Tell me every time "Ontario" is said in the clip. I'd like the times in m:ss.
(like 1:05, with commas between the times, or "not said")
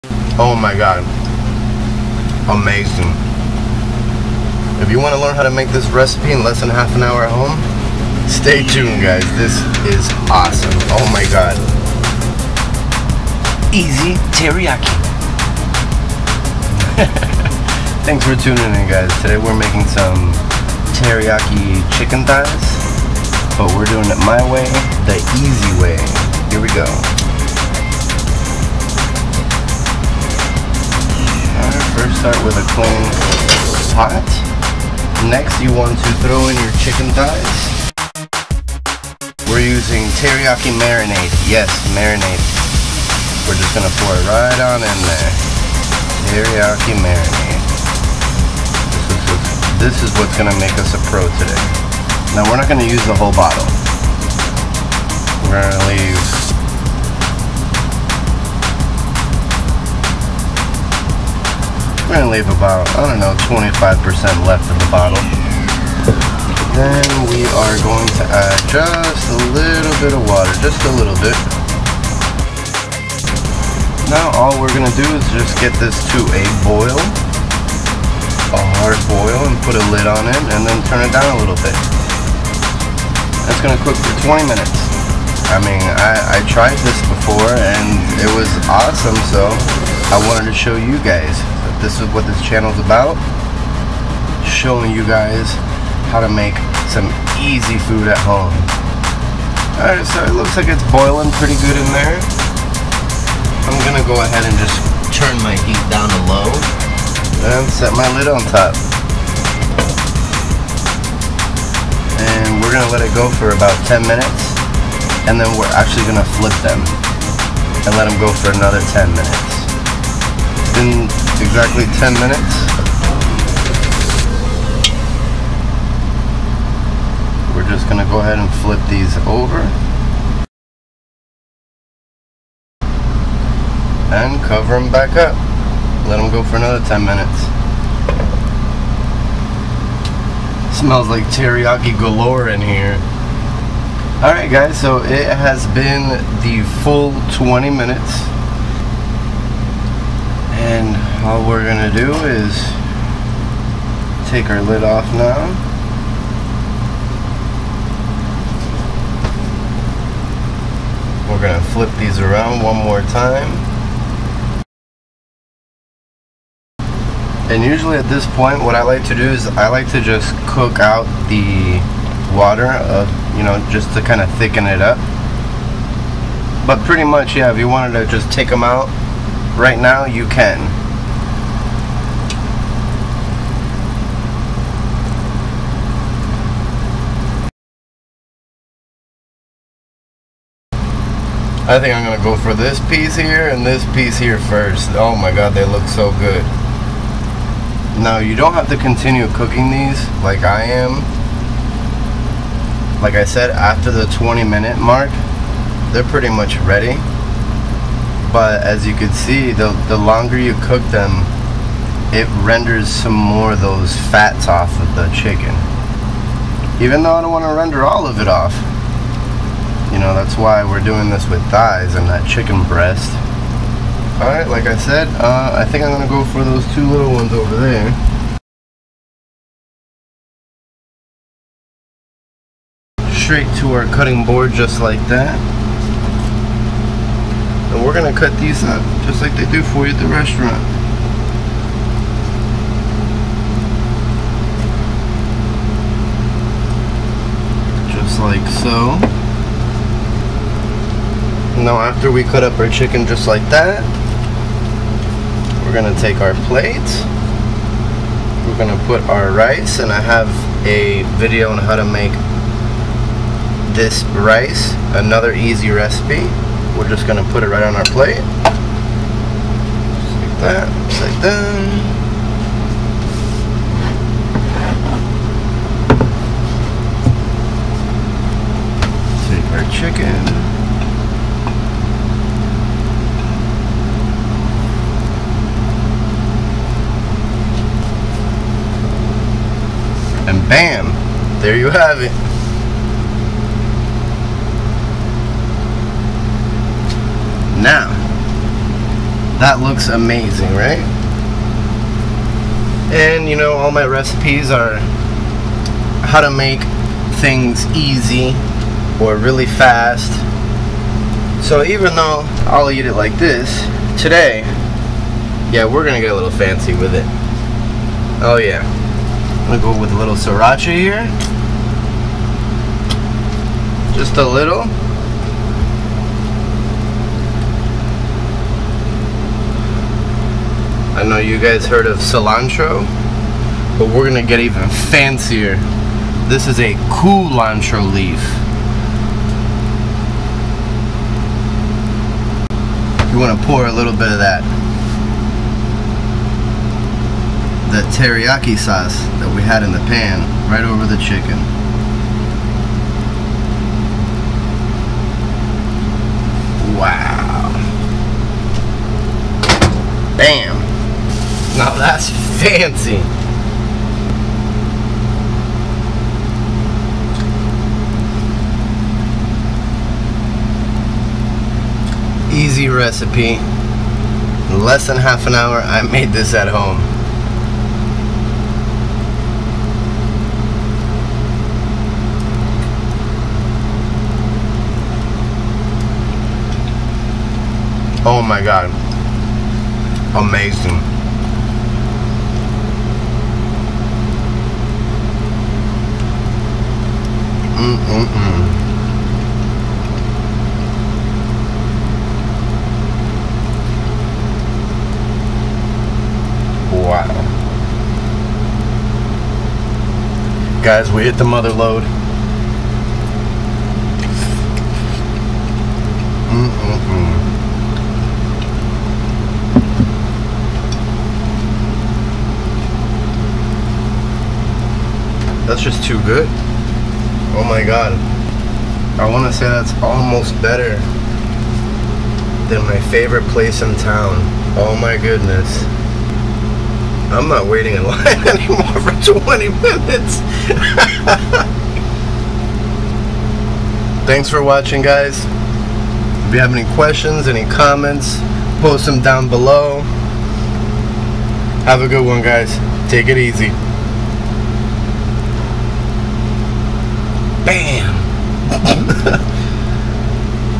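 not said.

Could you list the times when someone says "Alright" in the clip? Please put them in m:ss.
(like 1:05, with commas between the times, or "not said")
1:39, 2:24, 3:44.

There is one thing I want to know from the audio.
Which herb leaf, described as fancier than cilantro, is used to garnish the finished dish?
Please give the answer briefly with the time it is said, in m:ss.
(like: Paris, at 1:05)
culantro, at 5:37.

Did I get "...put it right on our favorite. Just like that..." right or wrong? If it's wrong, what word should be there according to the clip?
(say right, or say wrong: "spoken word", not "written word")
wrong: "plate", not "favorite".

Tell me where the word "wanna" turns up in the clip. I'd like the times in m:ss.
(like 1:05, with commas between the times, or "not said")
5:43.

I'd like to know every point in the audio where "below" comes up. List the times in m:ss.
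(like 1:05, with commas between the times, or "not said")
7:29.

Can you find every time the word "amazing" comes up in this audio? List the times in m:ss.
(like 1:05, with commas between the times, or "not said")
0:02, 4:59, 6:30.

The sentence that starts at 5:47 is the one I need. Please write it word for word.
the teriyaki sauce that we had in the pan right over the chicken.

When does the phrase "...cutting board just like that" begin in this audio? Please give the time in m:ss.
3:53.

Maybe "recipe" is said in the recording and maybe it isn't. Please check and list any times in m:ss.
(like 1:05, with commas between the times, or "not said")
0:05, 4:25, 5:03, 6:12.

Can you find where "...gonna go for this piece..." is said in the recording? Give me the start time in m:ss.
3:12.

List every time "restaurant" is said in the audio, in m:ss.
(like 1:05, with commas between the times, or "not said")
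4:00.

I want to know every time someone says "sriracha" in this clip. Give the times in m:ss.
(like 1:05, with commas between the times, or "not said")
5:20.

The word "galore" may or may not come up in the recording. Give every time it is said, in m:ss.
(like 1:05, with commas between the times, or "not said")
2:21.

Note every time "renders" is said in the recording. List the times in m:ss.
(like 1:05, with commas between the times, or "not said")
3:32, 3:37.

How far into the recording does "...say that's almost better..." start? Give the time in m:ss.
7:09.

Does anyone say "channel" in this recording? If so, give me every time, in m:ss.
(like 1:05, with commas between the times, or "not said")
1:32.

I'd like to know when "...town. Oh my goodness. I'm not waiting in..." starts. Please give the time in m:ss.
7:13.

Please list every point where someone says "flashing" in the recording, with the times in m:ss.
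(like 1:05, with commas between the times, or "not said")
not said.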